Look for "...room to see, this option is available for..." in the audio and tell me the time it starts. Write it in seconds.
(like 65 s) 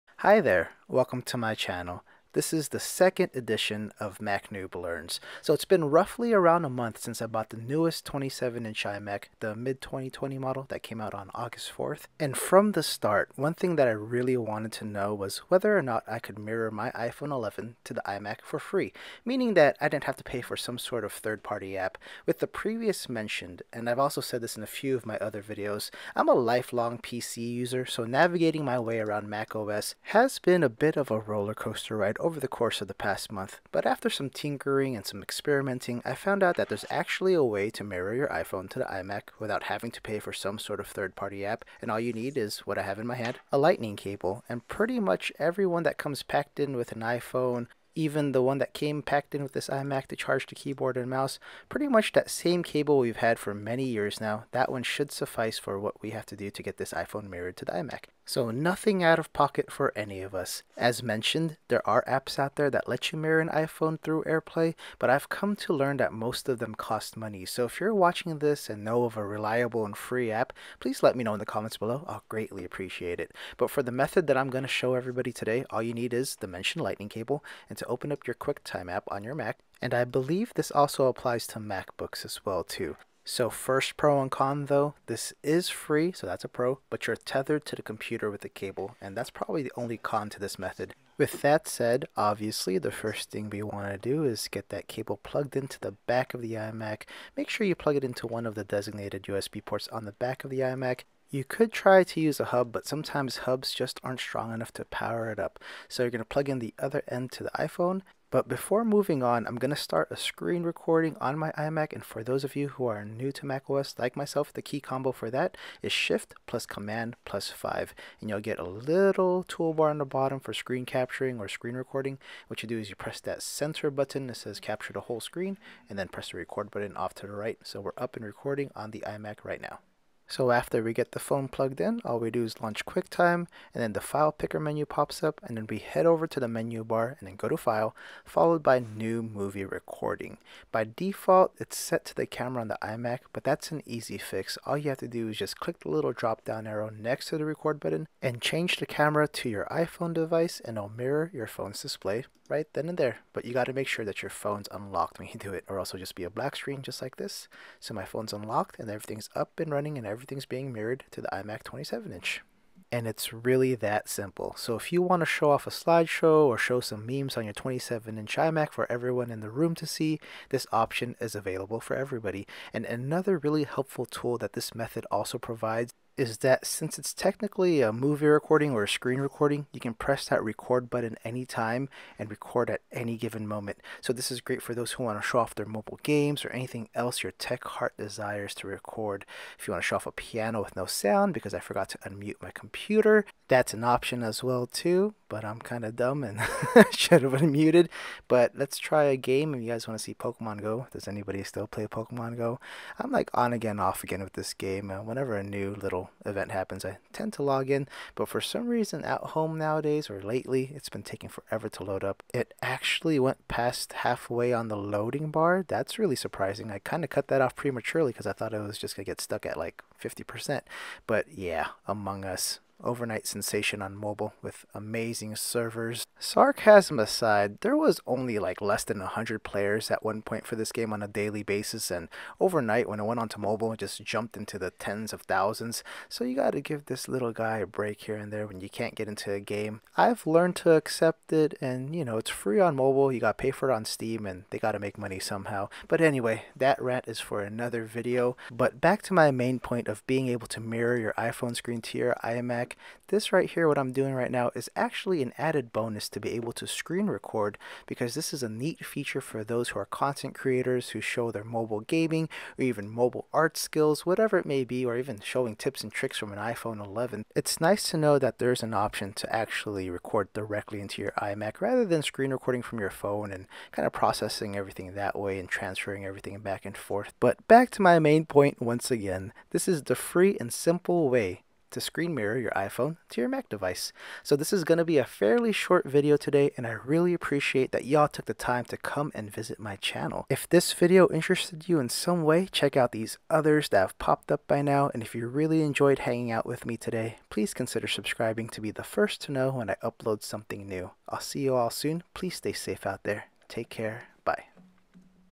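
169 s.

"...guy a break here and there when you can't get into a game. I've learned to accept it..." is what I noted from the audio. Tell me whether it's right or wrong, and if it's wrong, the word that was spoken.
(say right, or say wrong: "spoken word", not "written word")
right.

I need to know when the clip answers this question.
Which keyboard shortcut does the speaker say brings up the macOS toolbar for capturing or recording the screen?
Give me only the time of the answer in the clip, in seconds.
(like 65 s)
115 s.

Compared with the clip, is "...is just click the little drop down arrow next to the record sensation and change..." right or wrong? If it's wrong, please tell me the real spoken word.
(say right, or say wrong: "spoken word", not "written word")
wrong: "button", not "sensation".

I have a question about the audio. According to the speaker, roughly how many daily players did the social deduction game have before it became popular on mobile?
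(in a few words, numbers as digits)
Less than 100.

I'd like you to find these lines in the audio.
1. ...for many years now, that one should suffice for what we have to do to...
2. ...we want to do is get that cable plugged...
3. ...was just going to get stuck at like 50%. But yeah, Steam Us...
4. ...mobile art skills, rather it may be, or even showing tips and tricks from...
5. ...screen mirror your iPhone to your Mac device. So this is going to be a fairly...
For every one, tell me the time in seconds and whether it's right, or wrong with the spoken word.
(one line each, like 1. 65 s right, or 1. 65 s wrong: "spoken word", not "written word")
1. 53 s right
2. 93 s right
3. 218 s wrong: "Among", not "Steam"
4. 262 s wrong: "whatever", not "rather"
5. 281 s right.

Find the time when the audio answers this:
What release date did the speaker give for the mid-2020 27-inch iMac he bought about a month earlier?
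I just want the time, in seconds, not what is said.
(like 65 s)
11 s.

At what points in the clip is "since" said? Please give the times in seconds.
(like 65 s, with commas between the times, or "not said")
6 s, 176 s.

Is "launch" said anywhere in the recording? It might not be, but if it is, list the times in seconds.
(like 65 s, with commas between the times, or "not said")
132 s.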